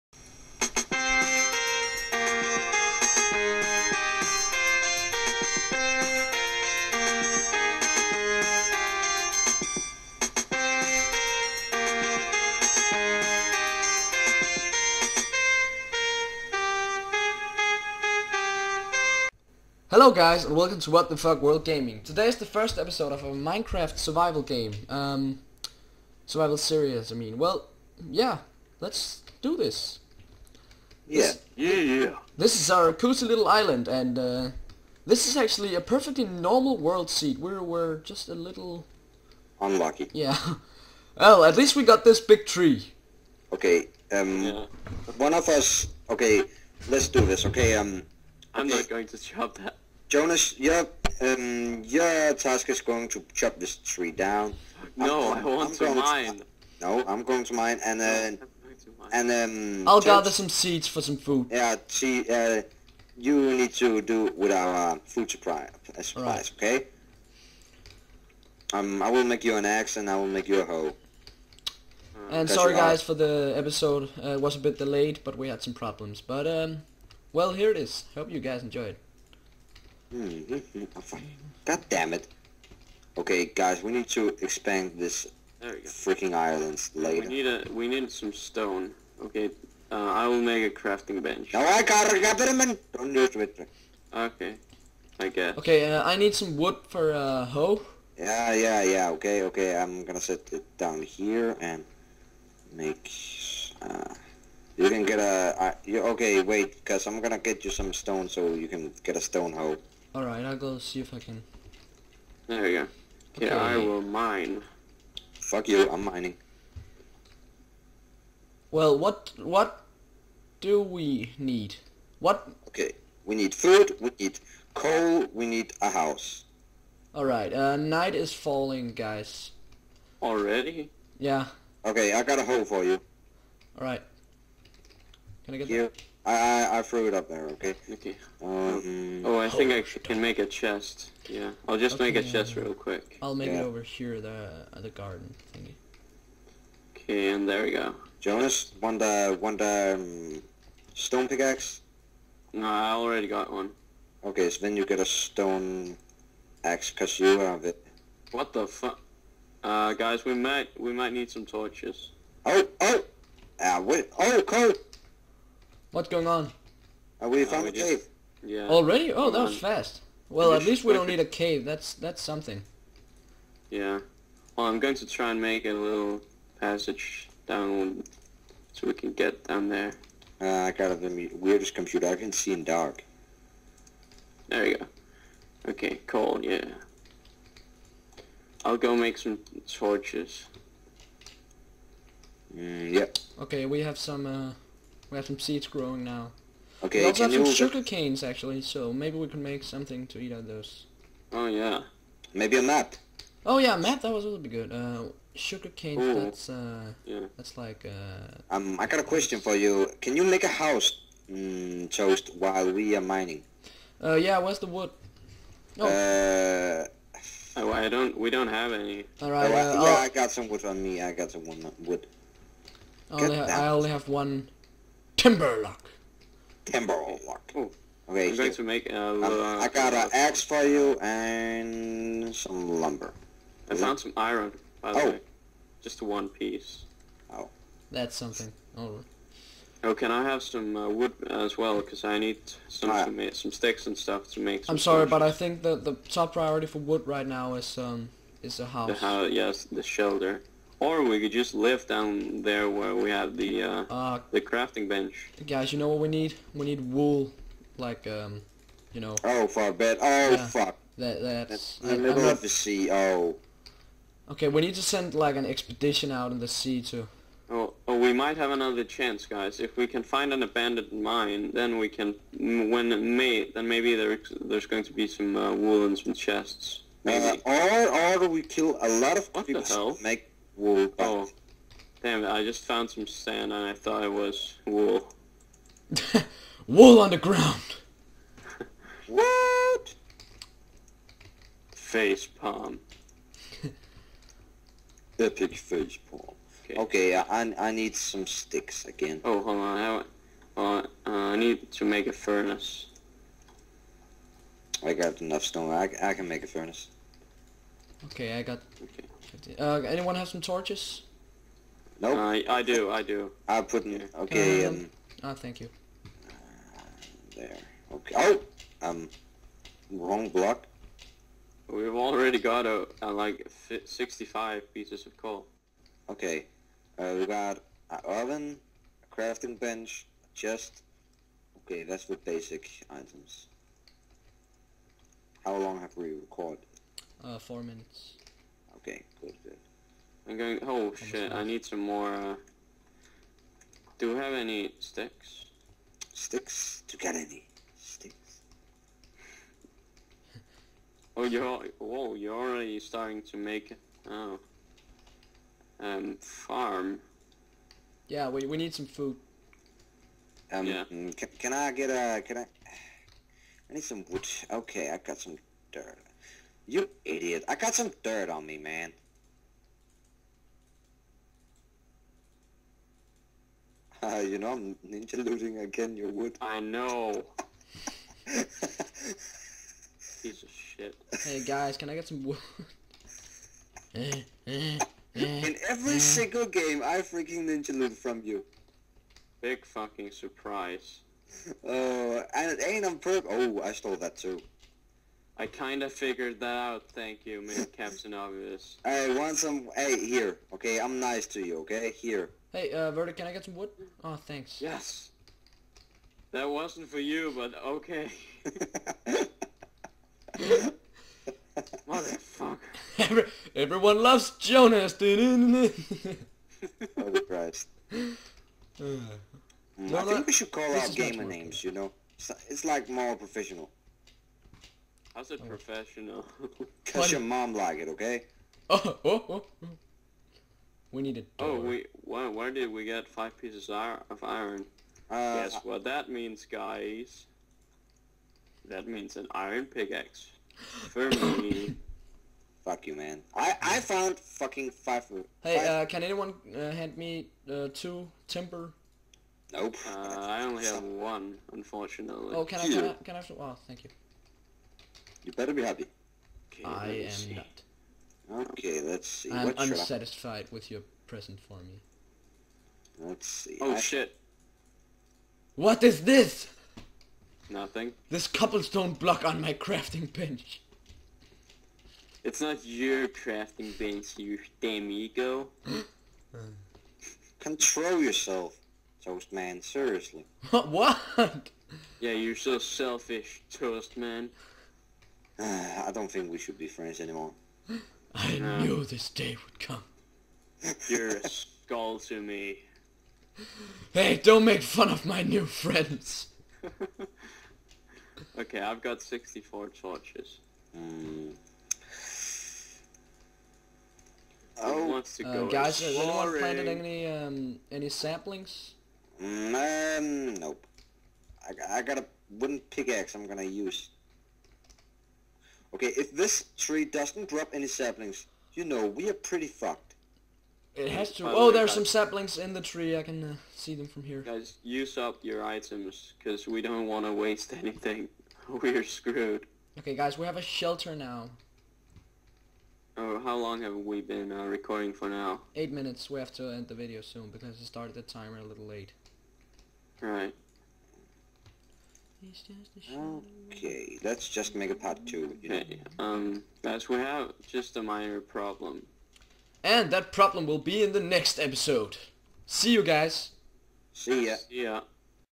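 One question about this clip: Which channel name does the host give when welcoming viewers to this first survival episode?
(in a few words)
What the Fuck World Gaming.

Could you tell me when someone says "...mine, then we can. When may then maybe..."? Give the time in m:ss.
4:30.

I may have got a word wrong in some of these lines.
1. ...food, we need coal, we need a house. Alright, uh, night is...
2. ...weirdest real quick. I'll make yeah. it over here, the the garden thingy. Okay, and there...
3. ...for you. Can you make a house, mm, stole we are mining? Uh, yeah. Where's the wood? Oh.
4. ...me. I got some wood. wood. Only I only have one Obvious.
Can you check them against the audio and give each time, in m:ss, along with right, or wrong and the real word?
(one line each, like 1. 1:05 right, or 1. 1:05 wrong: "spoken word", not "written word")
1. 2:03 right
2. 2:22 wrong: "chest", not "weirdest"
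3. 3:29 wrong: "while", not "stole"
4. 3:40 wrong: "Timberlock", not "Obvious".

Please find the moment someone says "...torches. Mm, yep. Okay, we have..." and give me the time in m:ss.
3:09.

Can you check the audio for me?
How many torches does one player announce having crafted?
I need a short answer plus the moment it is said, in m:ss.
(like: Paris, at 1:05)
64, at 8:19.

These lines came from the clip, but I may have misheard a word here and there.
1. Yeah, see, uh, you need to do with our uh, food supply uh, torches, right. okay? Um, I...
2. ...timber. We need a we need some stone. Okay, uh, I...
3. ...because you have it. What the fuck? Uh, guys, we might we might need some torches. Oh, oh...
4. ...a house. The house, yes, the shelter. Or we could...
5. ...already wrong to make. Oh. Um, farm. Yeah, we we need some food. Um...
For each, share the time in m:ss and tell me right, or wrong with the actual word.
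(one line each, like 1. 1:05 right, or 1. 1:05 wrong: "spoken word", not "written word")
1. 1:01 wrong: "supplies", not "torches"
2. 1:26 wrong: "later", not "timber"
3. 2:36 right
4. 4:08 right
5. 5:52 wrong: "starting", not "wrong".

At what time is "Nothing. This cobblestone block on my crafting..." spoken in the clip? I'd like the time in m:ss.
7:47.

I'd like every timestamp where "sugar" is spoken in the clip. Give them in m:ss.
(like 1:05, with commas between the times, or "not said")
3:17, 3:25.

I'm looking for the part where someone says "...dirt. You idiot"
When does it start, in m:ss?
6:05.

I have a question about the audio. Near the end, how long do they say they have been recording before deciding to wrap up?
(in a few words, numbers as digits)
8 minutes.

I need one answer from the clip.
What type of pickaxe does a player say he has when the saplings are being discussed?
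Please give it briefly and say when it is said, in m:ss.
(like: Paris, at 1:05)
wooden pickaxe, at 8:32.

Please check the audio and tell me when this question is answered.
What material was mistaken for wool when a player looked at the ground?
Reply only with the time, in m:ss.
4:43.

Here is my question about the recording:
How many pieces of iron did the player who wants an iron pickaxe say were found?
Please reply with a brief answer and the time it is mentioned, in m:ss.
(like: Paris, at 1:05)
5, at 7:13.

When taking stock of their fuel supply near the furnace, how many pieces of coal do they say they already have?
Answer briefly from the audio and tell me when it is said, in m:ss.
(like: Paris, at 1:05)
65, at 5:23.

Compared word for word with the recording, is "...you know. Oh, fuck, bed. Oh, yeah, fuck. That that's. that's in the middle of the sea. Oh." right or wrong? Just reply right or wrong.
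right.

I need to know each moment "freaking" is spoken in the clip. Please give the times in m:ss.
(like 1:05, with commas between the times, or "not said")
1:25, 6:27.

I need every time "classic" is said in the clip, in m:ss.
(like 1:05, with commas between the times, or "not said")
not said.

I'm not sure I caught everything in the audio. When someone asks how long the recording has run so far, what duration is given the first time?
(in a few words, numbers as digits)
4 minutes.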